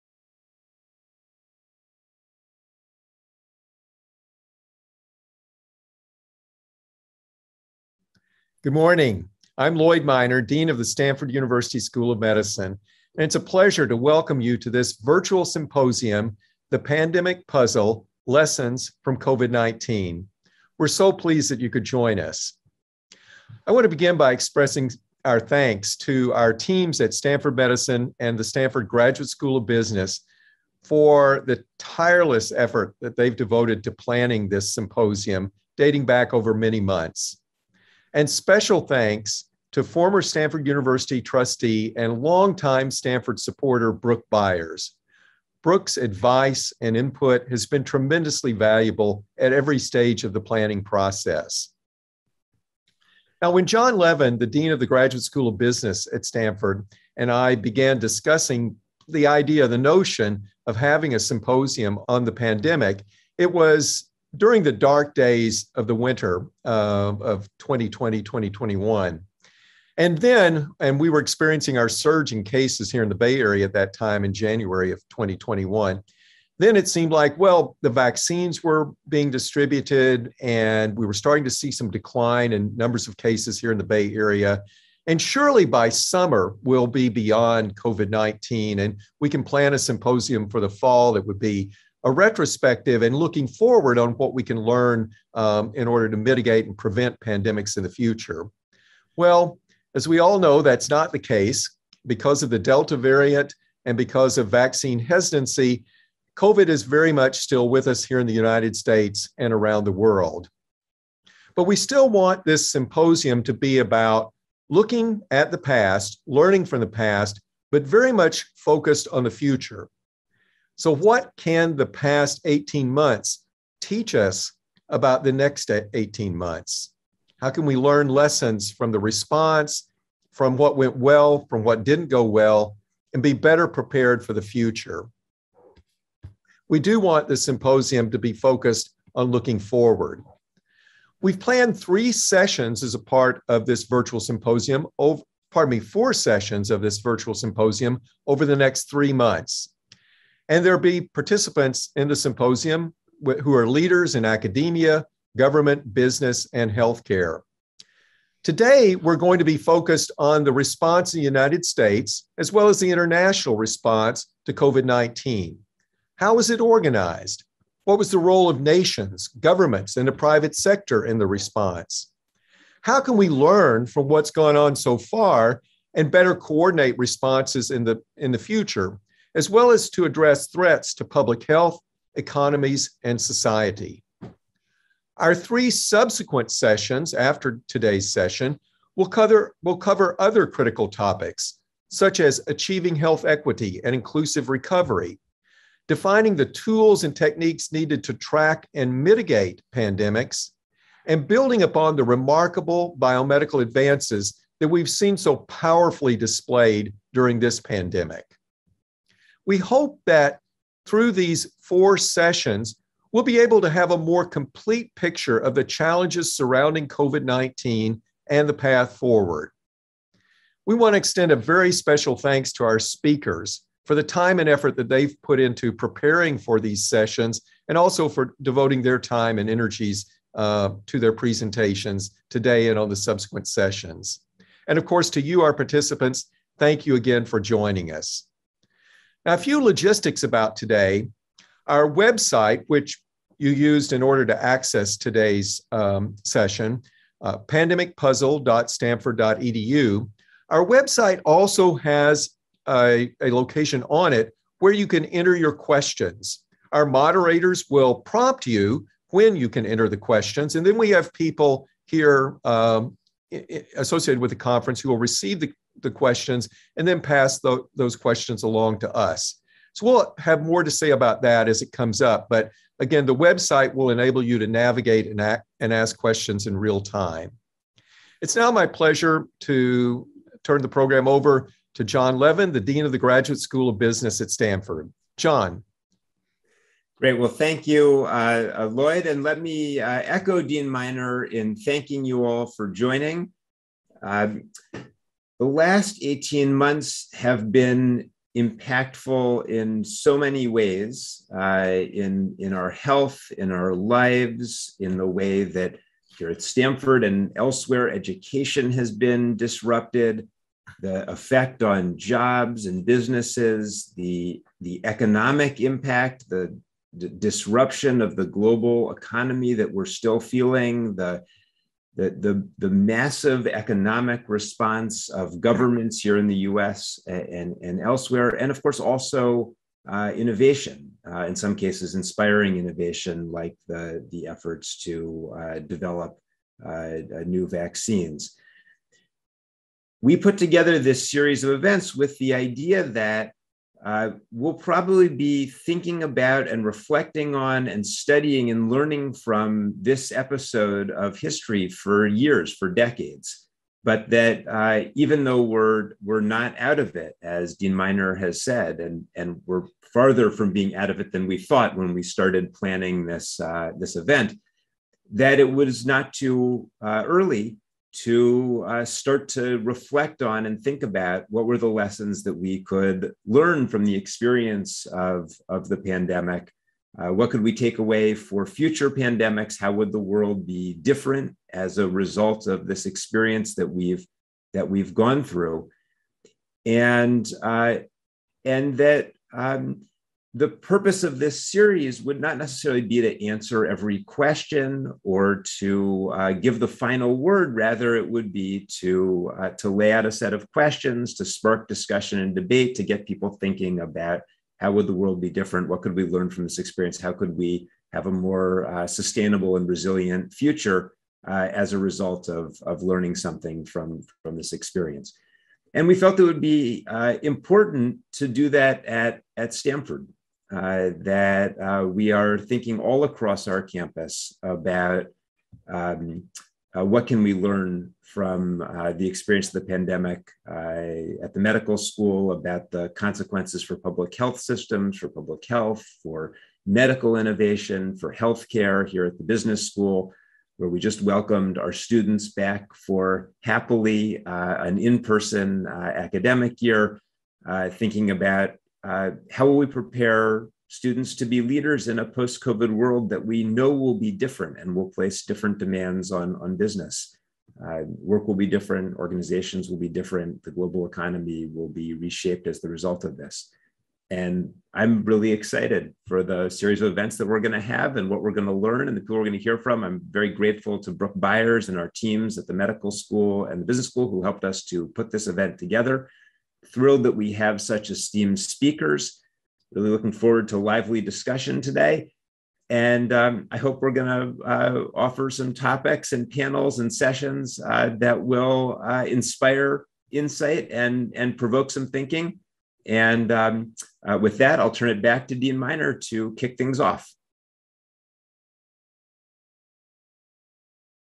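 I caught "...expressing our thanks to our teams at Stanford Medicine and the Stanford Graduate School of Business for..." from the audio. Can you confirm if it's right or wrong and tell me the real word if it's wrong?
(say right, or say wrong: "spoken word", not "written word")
right.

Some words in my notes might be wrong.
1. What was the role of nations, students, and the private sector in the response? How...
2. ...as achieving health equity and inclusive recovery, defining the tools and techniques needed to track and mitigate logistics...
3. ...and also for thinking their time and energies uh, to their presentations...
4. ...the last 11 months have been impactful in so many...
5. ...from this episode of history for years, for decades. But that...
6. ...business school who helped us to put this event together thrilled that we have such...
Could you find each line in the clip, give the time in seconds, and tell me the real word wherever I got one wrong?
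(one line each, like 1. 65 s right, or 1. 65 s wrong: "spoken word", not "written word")
1. 167 s wrong: "governments", not "students"
2. 192 s wrong: "pandemics", not "logistics"
3. 227 s wrong: "devoting", not "thinking"
4. 295 s wrong: "18", not "11"
5. 349 s right
6. 473 s right.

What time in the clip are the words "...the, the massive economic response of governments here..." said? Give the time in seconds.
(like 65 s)
322 s.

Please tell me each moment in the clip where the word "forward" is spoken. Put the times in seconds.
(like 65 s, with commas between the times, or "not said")
93 s, 139 s, 218 s, 480 s.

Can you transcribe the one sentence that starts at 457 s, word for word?
Uh, work will be different, organizations will be different, the global economy will be reshaped as the result of this.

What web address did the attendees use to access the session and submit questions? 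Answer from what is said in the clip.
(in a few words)
pandemicpuzzle.stanford.edu.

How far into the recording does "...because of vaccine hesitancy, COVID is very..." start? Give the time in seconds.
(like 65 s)
103 s.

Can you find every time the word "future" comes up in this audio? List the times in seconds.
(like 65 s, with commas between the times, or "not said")
97 s, 119 s, 134 s, 178 s, 378 s, 410 s.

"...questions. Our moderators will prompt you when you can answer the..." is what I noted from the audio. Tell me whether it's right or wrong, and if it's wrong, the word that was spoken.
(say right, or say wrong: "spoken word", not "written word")
wrong: "enter", not "answer".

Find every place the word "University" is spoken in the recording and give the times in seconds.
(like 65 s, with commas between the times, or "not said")
11 s, 40 s.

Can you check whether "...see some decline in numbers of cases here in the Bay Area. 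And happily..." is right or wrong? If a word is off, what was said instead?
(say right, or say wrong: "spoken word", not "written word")
wrong: "surely", not "happily".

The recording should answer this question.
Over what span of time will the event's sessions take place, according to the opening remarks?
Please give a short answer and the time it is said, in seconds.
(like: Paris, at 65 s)
3 months, at 148 s.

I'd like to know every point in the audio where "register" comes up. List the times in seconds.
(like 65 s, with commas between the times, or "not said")
not said.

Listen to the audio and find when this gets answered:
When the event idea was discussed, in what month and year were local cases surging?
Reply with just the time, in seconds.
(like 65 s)
74 s.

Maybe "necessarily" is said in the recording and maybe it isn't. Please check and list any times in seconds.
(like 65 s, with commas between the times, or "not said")
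392 s.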